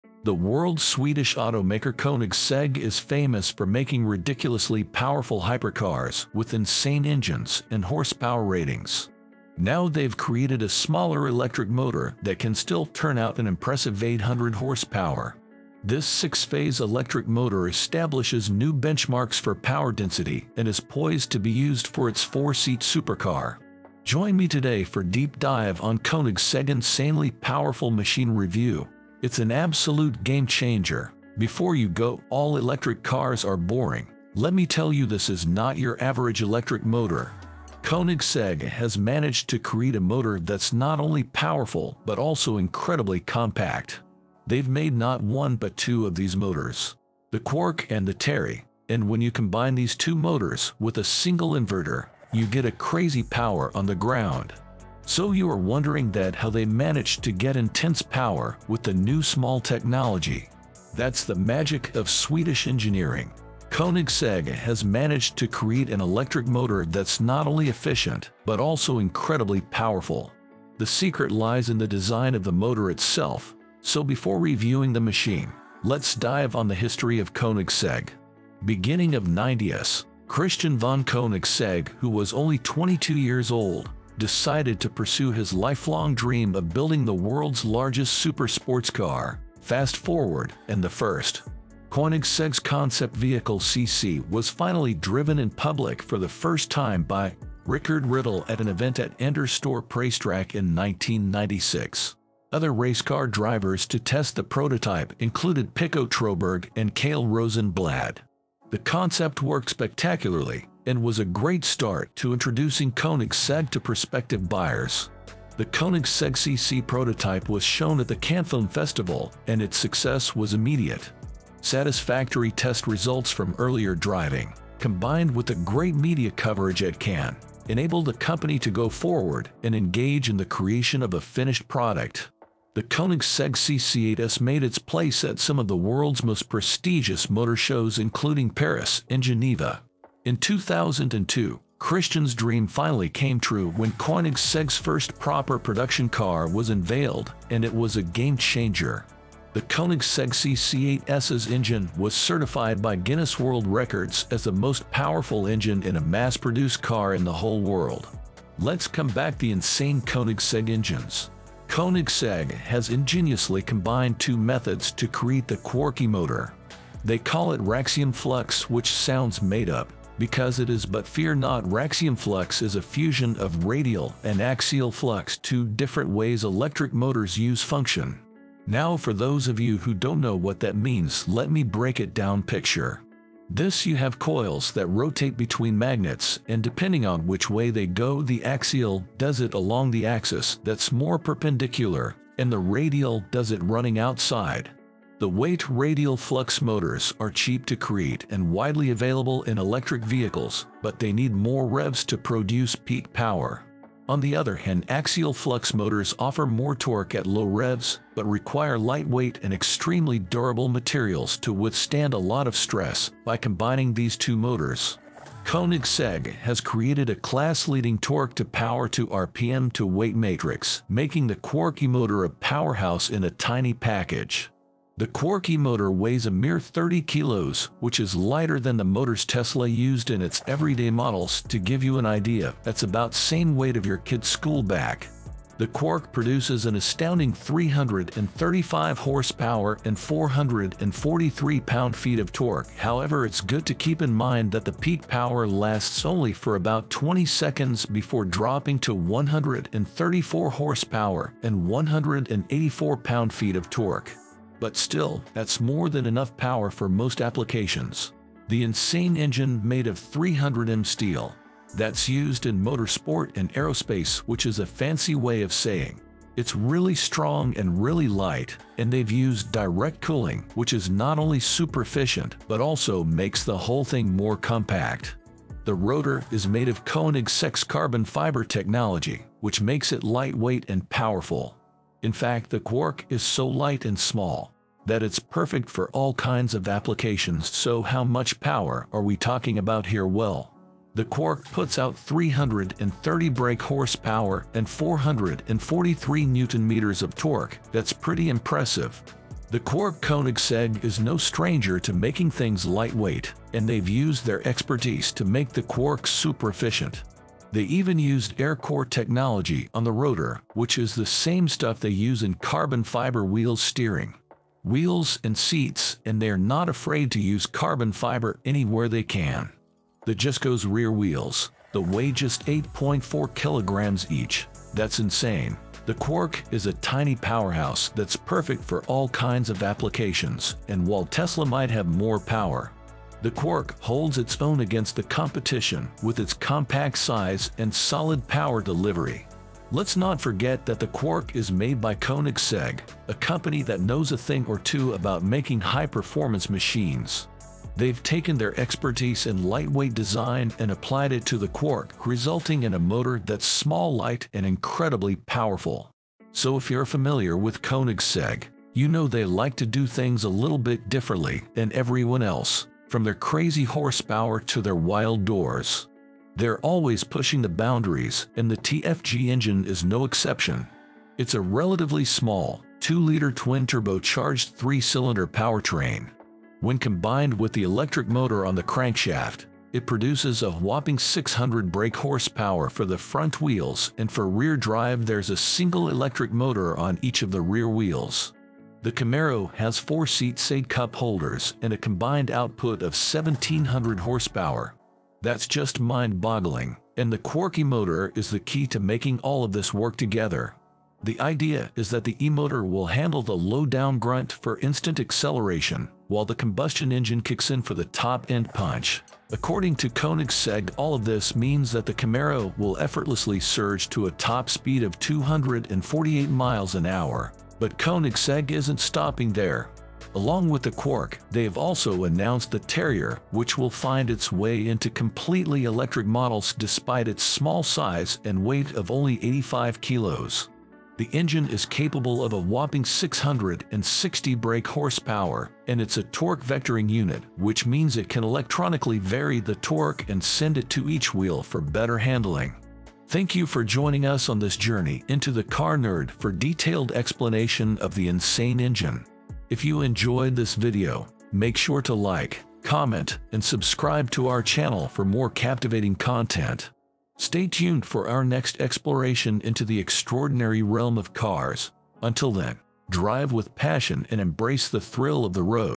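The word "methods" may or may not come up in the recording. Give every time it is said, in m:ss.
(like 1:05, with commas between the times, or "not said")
2:44.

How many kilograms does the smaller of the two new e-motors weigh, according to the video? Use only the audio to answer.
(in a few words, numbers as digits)
30 kilos.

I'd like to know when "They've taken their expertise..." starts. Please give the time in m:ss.
5:47.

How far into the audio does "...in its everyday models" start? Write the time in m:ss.
3:50.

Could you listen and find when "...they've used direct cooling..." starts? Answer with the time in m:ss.
4:28.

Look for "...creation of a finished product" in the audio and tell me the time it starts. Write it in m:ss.
2:10.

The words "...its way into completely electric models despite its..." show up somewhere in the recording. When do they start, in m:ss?
7:04.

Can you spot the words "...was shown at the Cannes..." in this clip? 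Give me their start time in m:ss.
1:57.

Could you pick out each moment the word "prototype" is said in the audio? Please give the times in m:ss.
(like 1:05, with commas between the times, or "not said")
1:44, 1:56.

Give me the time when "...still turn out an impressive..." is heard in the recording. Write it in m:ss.
0:12.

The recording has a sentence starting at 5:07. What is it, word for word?
They even used Aircore technology on the rotor, which is the same stuff they use in carbon fiber wheel steering.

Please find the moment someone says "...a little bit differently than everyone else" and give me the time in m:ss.
6:00.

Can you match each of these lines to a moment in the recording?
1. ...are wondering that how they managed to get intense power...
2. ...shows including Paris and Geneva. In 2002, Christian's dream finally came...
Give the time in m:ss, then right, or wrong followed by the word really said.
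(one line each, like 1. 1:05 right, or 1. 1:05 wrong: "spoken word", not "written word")
1. 0:55 right
2. 2:17 right.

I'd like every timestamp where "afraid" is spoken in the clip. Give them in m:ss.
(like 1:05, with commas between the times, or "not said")
5:16.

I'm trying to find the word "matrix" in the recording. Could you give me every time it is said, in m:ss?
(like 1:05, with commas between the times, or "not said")
3:40.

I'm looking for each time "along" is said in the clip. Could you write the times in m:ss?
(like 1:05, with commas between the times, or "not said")
3:09, 7:00.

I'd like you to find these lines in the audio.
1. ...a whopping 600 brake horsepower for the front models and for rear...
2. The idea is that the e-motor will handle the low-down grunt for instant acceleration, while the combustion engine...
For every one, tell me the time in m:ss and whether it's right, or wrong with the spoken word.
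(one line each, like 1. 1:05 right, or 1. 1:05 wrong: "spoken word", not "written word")
1. 6:20 wrong: "wheels", not "models"
2. 6:41 right.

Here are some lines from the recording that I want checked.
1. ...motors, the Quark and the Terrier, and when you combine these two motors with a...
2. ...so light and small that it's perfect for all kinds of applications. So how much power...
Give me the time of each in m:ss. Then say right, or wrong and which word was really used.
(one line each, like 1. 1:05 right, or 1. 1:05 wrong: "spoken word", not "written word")
1. 0:46 right
2. 4:43 right.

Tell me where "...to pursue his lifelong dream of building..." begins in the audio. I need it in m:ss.
1:24.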